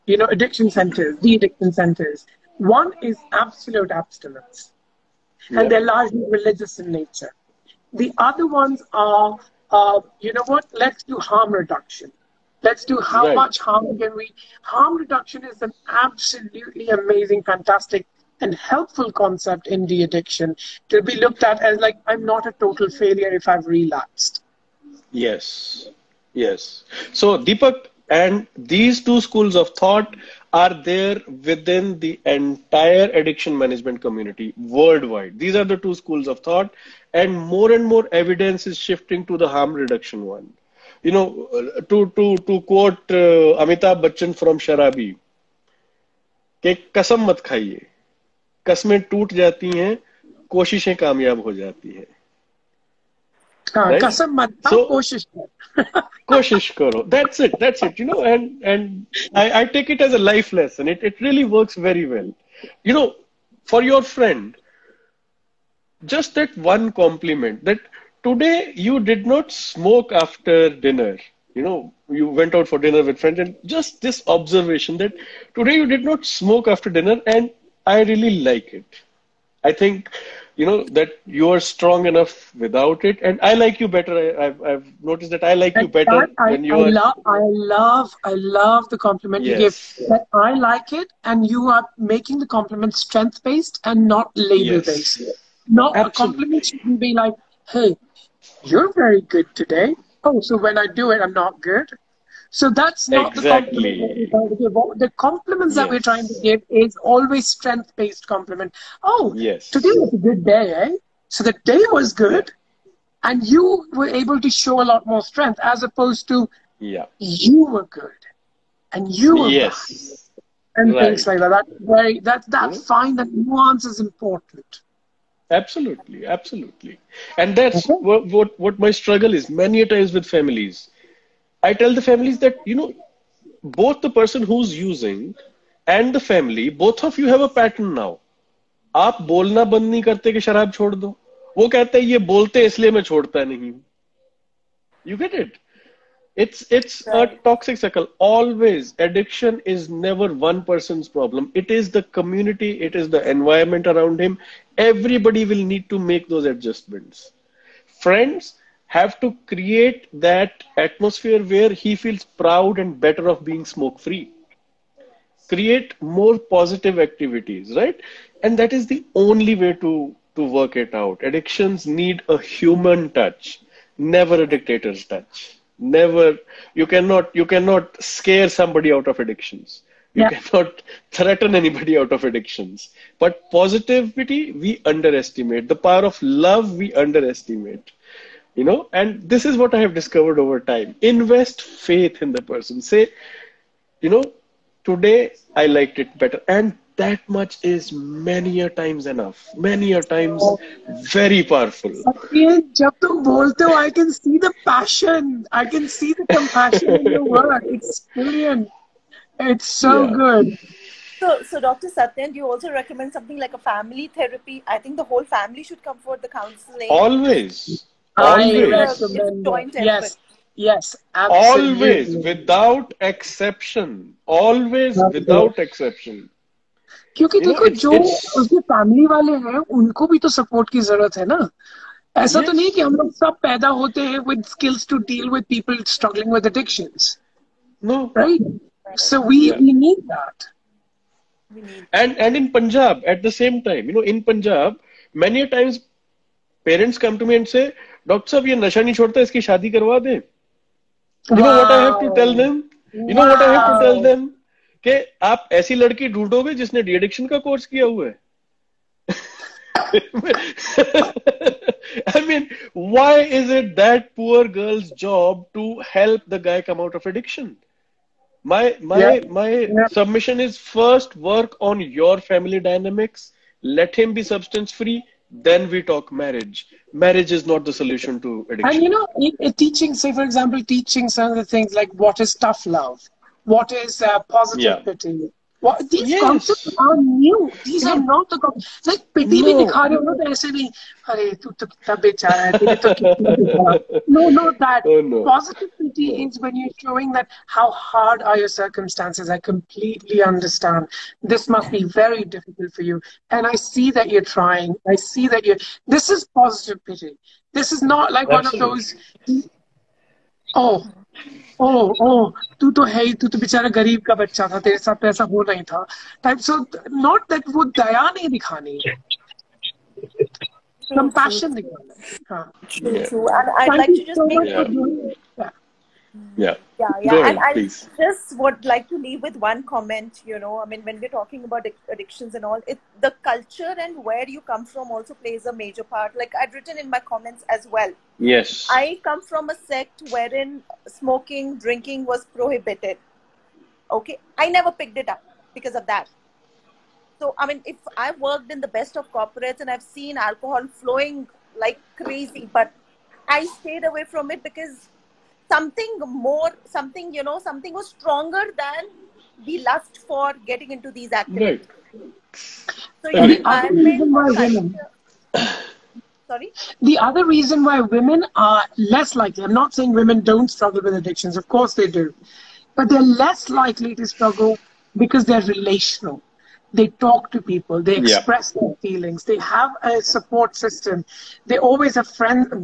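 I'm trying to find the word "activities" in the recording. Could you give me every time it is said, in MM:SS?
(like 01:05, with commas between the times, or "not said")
02:46, 06:01.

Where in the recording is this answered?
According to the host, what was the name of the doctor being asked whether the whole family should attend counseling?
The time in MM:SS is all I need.
03:31.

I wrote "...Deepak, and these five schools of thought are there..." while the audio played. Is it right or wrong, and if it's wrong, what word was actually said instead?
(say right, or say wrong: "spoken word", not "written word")
wrong: "two", not "five".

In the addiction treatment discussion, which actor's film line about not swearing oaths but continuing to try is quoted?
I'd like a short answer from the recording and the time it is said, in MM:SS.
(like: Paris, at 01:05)
Amitabh Bachchan, at 00:43.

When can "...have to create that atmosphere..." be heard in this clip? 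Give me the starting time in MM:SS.
02:38.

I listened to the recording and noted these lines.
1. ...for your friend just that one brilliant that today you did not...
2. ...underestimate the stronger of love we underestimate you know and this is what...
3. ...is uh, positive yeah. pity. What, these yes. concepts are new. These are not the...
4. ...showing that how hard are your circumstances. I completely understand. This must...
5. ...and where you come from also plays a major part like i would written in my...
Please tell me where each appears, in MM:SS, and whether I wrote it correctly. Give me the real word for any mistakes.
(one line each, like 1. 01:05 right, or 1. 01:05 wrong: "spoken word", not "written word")
1. 01:03 wrong: "compliment", not "brilliant"
2. 03:04 wrong: "power", not "stronger"
3. 04:43 right
4. 04:56 right
5. 05:33 right.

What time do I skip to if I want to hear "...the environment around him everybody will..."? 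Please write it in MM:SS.
02:33.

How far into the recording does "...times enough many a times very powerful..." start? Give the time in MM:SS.
03:18.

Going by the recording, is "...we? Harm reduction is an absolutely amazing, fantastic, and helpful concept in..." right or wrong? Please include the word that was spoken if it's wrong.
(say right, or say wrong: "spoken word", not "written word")
right.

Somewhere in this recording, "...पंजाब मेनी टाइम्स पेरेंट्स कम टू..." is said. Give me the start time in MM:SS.
04:04.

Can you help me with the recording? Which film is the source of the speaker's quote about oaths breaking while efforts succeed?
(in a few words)
Sharabi.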